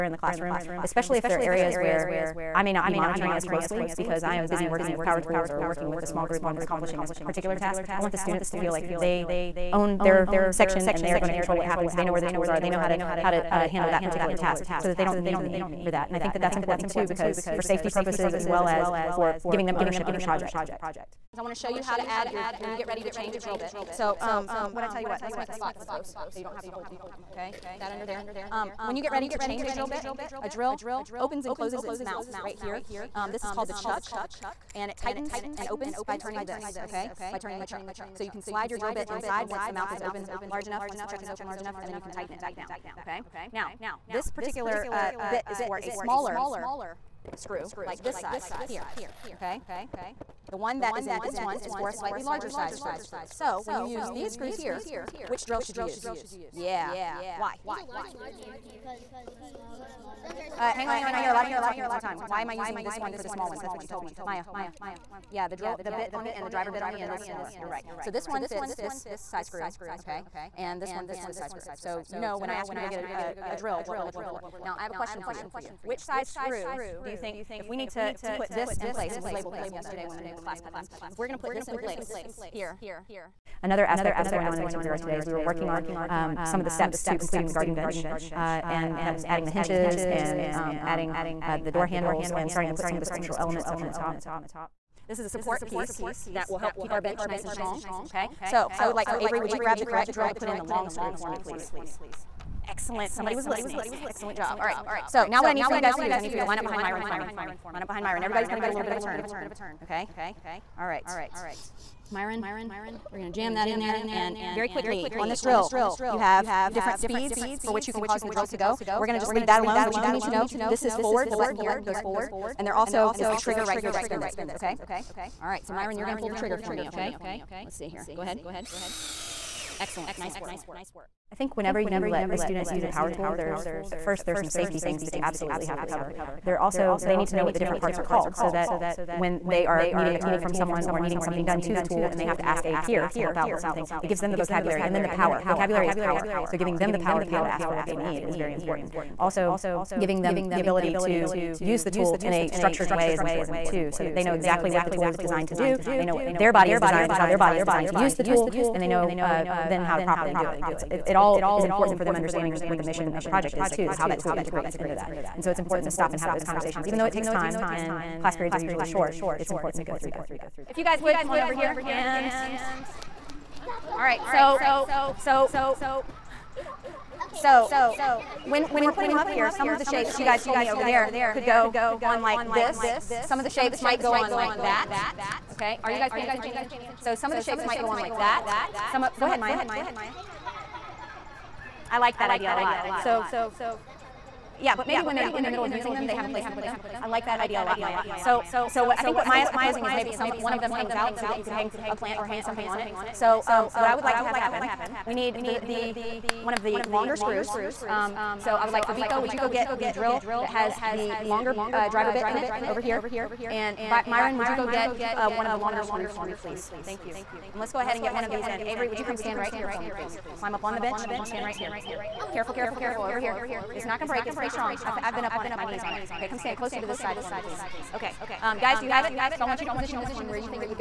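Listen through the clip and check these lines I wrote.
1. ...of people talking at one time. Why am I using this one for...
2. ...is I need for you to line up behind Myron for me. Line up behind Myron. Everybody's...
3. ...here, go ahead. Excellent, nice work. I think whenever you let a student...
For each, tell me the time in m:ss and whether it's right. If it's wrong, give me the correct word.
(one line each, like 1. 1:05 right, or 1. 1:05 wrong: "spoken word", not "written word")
1. 1:01 right
2. 1:46 right
3. 2:07 right.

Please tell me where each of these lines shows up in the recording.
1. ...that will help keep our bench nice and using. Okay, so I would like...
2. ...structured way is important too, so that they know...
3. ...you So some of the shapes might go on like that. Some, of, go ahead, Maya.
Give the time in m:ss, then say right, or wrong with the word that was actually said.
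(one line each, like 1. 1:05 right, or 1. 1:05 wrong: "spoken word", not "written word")
1. 1:36 wrong: "strong", not "using"
2. 2:32 right
3. 3:06 right.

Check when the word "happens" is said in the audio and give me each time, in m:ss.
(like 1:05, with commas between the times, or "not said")
0:11, 3:24.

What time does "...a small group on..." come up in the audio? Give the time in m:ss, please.
0:06.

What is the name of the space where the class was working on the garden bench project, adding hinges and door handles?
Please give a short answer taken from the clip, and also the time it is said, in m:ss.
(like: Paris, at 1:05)
Tinker Yard, at 1:24.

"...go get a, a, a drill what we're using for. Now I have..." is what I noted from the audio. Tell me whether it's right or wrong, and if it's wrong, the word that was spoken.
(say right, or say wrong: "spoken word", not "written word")
wrong: "looking", not "using".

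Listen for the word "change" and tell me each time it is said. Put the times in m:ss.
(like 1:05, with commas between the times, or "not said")
0:23, 0:29.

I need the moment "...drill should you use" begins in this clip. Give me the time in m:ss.
0:55.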